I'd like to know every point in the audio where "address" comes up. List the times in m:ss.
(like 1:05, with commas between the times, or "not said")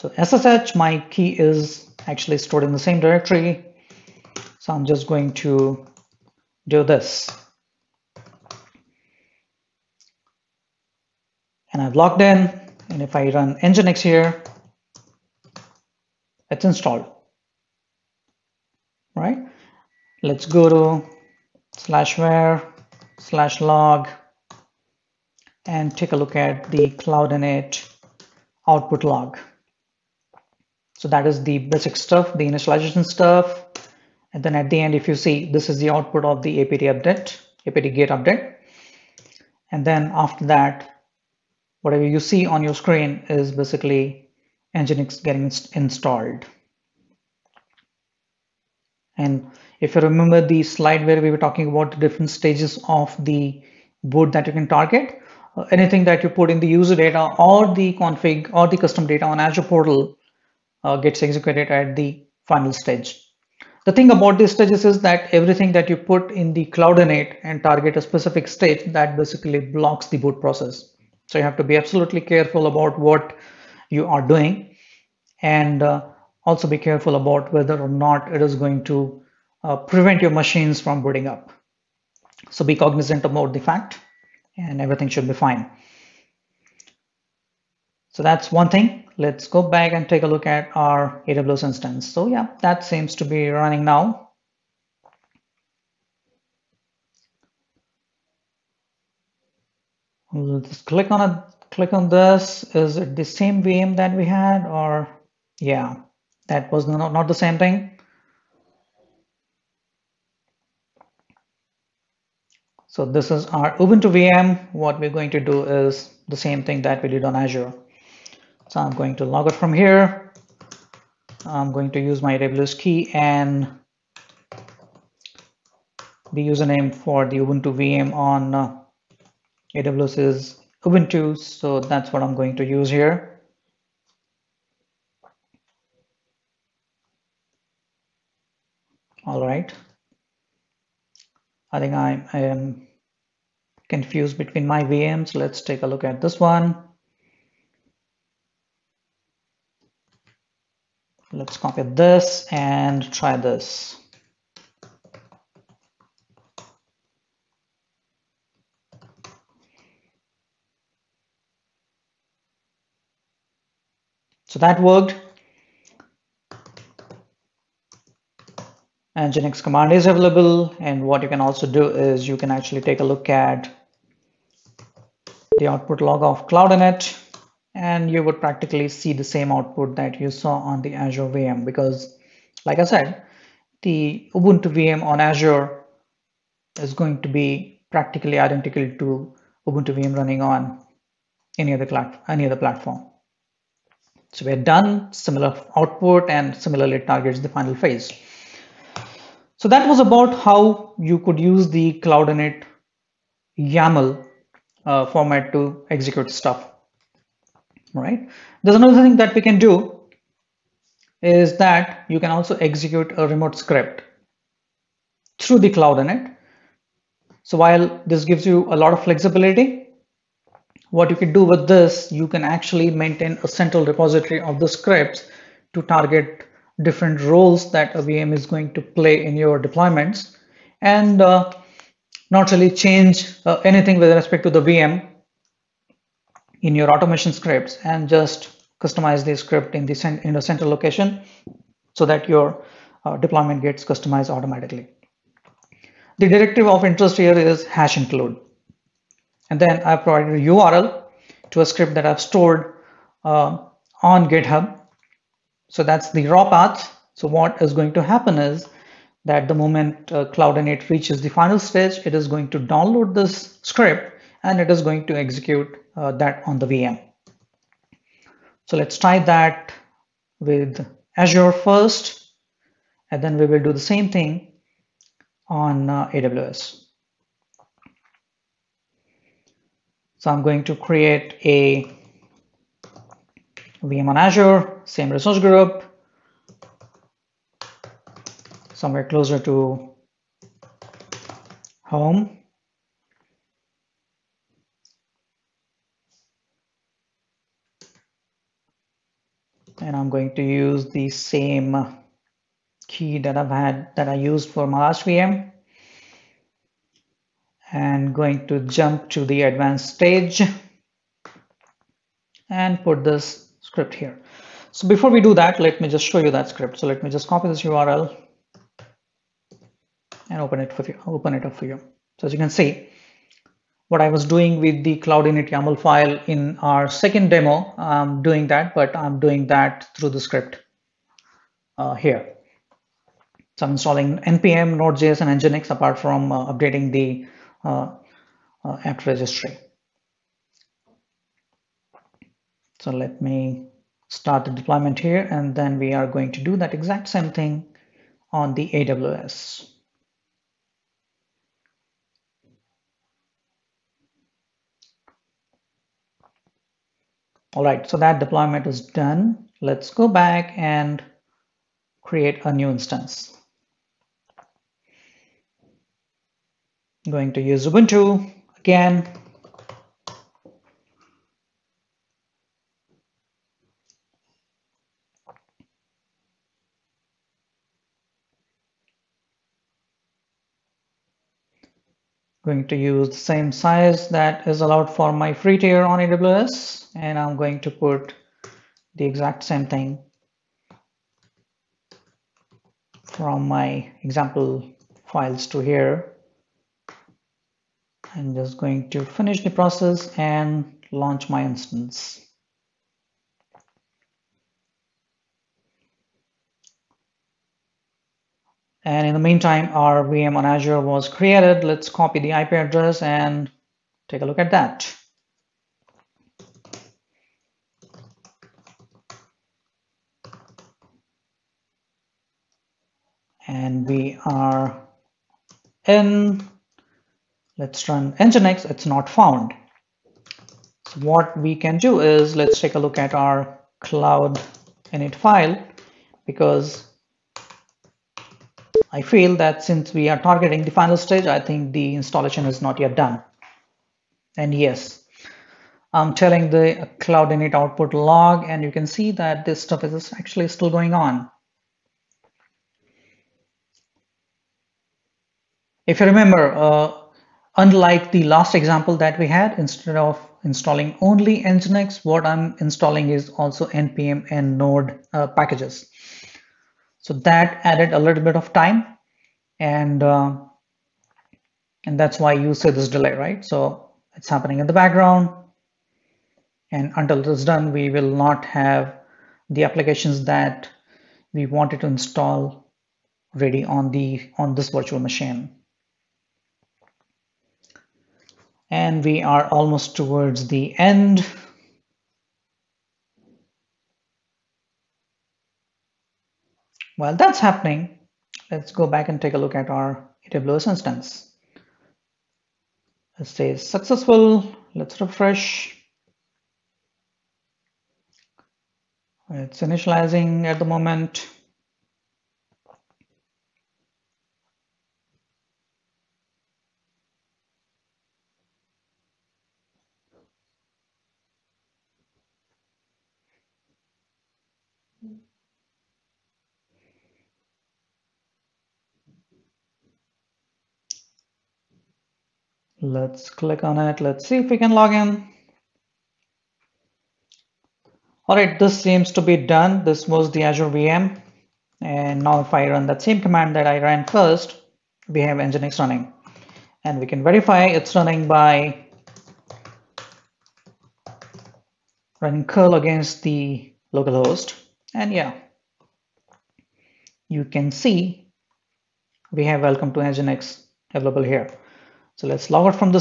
6:52.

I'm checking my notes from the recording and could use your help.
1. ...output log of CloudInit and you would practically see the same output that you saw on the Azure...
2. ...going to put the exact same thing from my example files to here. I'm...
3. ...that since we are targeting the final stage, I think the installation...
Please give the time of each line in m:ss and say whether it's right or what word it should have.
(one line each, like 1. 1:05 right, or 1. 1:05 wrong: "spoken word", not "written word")
1. 2:55 right
2. 6:27 right
3. 7:19 right.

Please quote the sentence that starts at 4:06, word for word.
The directive of interest here is hash include.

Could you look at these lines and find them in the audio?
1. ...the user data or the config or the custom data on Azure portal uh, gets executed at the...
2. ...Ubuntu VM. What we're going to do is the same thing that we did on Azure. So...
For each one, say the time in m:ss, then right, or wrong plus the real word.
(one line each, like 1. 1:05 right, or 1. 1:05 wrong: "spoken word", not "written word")
1. 0:56 right
2. 1:53 right.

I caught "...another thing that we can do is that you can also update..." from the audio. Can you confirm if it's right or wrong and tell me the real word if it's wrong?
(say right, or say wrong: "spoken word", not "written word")
wrong: "execute", not "update".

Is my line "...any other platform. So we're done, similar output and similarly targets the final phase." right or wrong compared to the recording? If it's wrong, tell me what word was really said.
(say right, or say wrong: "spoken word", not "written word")
right.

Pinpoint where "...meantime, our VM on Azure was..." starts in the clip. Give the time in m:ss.
6:49.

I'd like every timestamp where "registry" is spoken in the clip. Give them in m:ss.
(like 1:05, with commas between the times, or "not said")
5:39.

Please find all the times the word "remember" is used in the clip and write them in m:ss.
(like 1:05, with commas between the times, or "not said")
0:49, 7:36.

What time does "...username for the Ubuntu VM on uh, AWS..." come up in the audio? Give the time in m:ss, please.
2:06.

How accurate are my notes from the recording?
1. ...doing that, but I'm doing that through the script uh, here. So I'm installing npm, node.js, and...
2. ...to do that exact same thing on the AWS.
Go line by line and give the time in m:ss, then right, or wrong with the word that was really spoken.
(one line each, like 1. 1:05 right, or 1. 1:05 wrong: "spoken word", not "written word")
1. 5:28 right
2. 5:46 right.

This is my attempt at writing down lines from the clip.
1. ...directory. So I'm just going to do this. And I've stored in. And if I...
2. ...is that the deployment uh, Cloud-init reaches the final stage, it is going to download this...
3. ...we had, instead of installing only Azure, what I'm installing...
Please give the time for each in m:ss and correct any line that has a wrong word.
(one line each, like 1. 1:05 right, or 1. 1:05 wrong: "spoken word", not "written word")
1. 0:02 wrong: "logged", not "stored"
2. 4:18 wrong: "moment", not "deployment"
3. 7:39 wrong: "Nginx", not "Azure".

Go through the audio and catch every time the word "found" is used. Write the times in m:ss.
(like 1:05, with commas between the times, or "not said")
7:09.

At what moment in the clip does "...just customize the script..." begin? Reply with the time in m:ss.
3:58.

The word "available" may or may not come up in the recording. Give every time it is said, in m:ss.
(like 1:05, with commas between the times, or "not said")
2:50, 9:20.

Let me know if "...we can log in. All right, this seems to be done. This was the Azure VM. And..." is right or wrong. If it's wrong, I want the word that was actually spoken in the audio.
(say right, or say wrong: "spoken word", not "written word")
right.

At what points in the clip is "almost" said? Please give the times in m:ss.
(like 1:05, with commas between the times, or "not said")
8:09.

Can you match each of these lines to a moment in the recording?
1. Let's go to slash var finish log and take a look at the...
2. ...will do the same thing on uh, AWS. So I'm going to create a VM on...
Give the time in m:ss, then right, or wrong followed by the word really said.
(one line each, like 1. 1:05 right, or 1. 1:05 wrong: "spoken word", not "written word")
1. 0:20 wrong: "slash", not "finish"
2. 4:33 right.